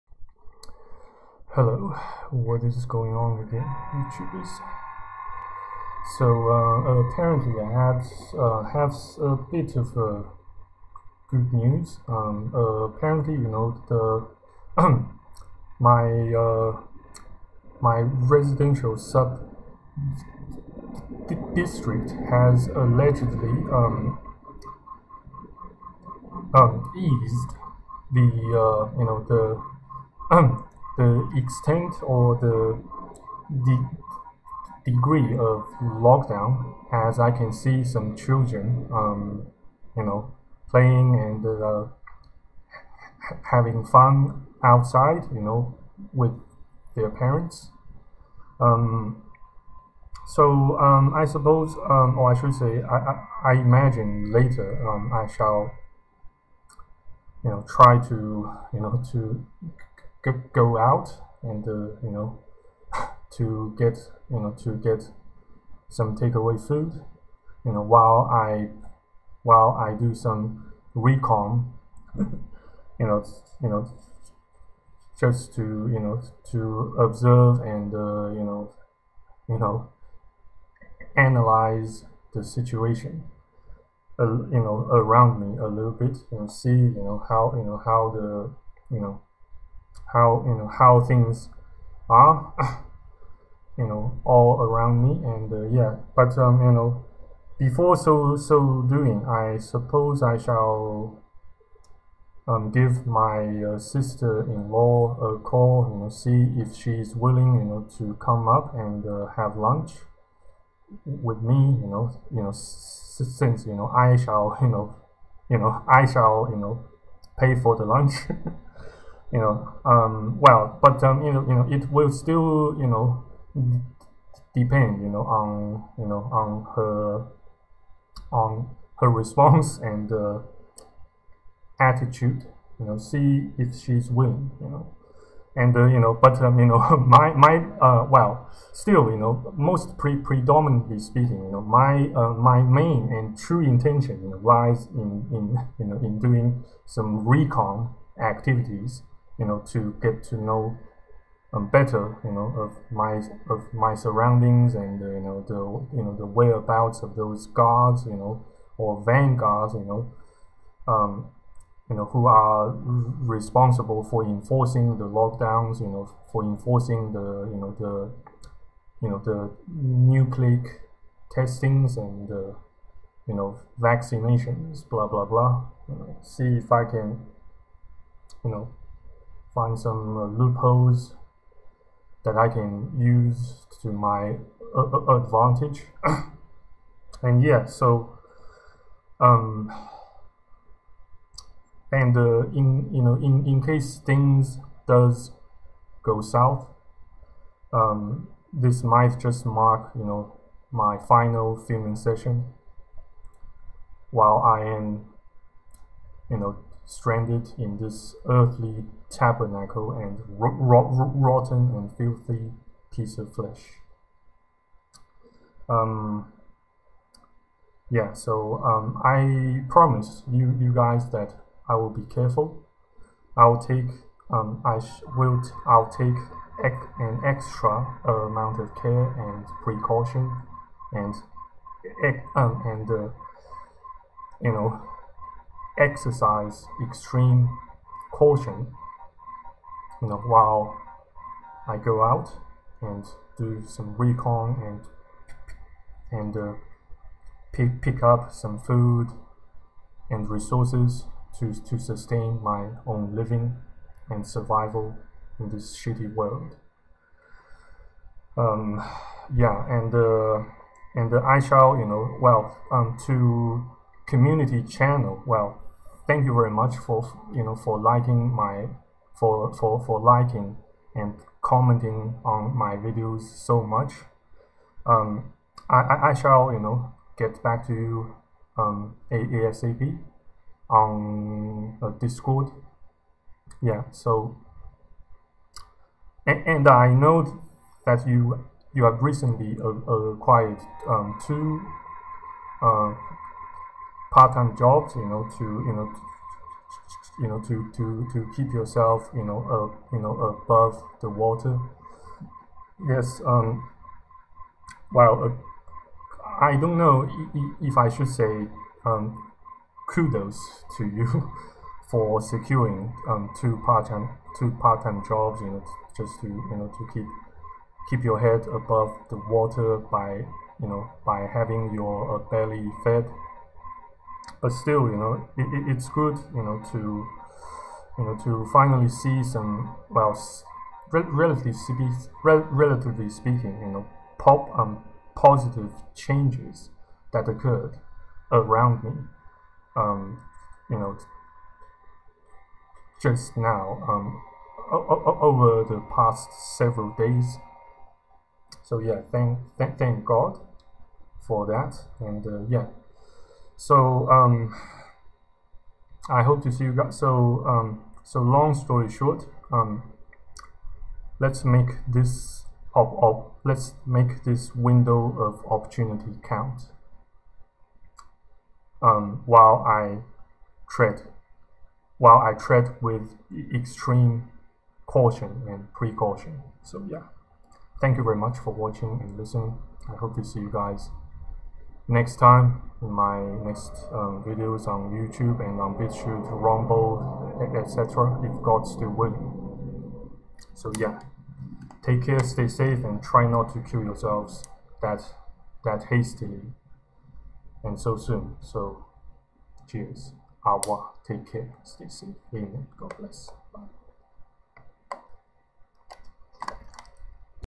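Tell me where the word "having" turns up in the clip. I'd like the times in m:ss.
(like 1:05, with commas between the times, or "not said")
0:43, 5:21.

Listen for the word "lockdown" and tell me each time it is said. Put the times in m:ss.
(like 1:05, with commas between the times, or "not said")
0:35, 2:45.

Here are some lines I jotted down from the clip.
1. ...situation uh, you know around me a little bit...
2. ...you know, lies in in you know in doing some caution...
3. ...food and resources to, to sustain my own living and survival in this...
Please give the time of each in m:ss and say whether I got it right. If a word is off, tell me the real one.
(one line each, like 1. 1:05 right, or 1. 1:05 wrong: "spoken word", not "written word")
1. 1:22 right
2. 2:24 wrong: "recon", not "caution"
3. 4:08 right.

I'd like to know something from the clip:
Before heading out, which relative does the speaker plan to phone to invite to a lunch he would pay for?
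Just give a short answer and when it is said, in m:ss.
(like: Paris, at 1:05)
Sister-in-law, at 1:43.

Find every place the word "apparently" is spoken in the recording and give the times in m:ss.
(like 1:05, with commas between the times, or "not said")
0:07, 0:12.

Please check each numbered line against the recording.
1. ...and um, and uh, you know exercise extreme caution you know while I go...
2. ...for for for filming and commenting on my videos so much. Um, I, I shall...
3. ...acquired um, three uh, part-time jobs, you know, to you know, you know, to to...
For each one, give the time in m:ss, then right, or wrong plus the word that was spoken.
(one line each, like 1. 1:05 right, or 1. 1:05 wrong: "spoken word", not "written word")
1. 3:50 right
2. 4:29 wrong: "liking", not "filming"
3. 4:50 wrong: "two", not "three".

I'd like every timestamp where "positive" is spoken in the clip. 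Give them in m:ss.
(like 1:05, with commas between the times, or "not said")
5:35.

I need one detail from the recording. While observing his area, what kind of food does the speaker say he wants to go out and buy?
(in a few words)
Takeaway food.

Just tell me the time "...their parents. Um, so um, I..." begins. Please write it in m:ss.
0:46.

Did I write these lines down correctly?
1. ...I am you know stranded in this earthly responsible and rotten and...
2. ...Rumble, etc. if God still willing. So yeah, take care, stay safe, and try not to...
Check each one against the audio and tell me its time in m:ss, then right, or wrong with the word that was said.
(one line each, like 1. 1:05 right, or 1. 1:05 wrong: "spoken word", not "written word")
1. 3:24 wrong: "tabernacle", not "responsible"
2. 6:26 right.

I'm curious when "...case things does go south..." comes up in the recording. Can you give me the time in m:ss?
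3:13.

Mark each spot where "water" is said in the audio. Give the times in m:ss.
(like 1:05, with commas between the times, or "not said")
5:01, 5:19.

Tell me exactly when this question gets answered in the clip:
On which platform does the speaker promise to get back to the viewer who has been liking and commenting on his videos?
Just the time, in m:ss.
4:42.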